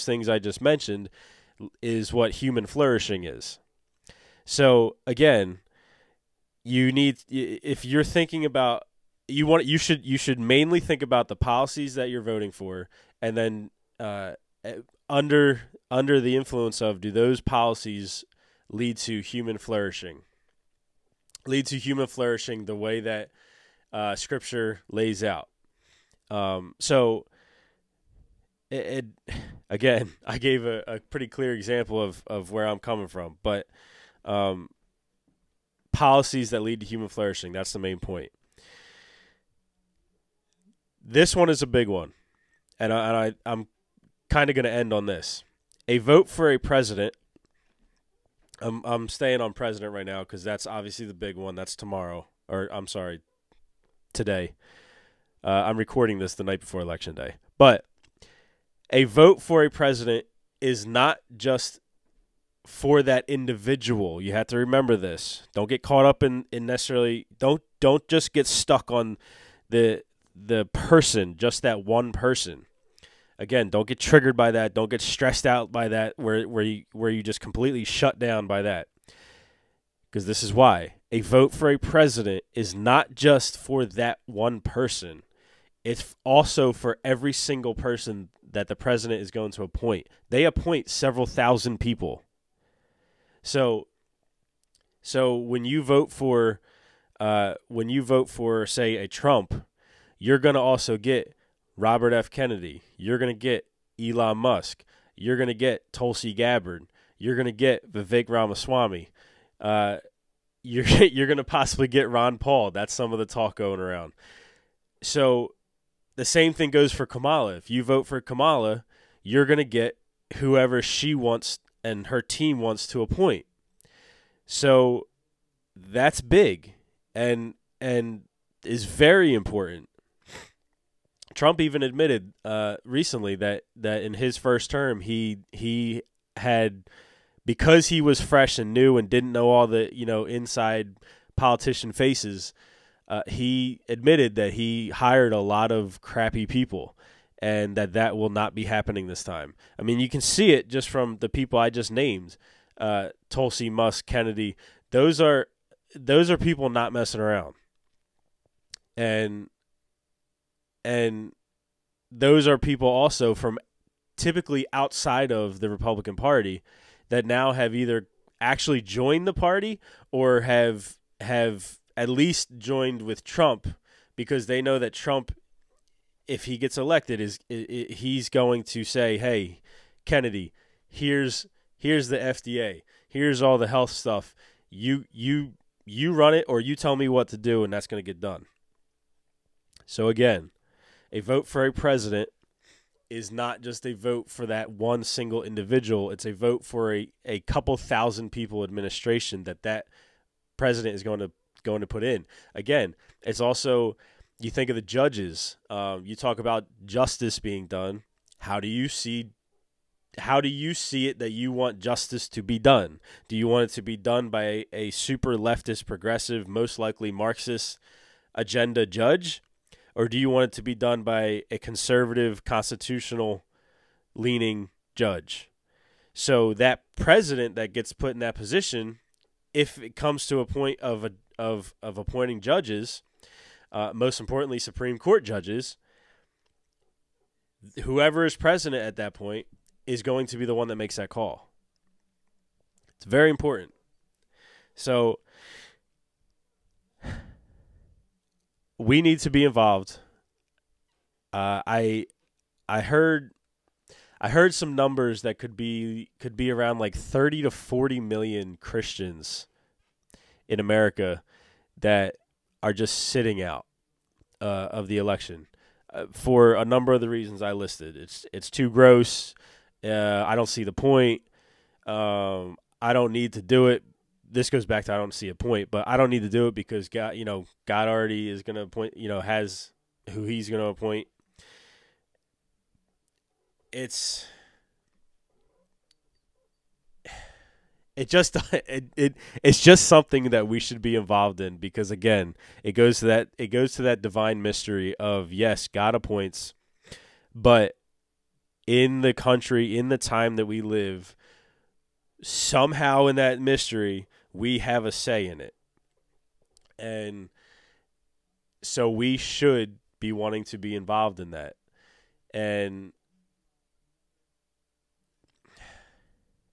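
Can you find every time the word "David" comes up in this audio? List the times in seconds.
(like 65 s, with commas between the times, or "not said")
not said.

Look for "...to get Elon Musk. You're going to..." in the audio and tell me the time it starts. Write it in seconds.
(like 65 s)
103 s.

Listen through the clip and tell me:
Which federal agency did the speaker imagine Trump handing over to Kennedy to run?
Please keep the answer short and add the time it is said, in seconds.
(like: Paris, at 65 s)
FDA, at 182 s.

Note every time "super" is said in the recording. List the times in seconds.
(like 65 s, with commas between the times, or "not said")
214 s.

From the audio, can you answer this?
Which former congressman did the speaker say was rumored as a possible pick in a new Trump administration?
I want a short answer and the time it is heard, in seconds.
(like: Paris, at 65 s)
Ron Paul, at 112 s.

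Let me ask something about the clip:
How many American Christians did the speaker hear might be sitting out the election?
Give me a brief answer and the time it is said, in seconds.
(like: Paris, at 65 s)
30 to 40 million, at 256 s.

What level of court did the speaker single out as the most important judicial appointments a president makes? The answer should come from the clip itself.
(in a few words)
Supreme Court.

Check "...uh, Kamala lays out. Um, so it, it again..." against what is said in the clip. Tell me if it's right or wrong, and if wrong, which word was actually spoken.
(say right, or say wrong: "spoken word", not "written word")
wrong: "Scripture", not "Kamala".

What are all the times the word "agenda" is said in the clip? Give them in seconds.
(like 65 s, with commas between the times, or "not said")
218 s.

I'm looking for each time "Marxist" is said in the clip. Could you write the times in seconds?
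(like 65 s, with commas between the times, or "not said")
217 s.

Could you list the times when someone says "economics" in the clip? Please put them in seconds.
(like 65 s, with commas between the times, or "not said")
not said.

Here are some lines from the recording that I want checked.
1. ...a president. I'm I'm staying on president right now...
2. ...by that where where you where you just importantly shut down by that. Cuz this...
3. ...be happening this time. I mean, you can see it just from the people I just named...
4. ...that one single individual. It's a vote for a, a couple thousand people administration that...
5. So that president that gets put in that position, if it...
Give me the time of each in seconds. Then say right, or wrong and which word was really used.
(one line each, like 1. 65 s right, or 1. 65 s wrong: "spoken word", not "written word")
1. 46 s right
2. 75 s wrong: "completely", not "importantly"
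3. 148 s right
4. 194 s right
5. 226 s right.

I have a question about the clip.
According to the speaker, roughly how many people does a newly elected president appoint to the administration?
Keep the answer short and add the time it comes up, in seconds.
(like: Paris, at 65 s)
several thousand, at 90 s.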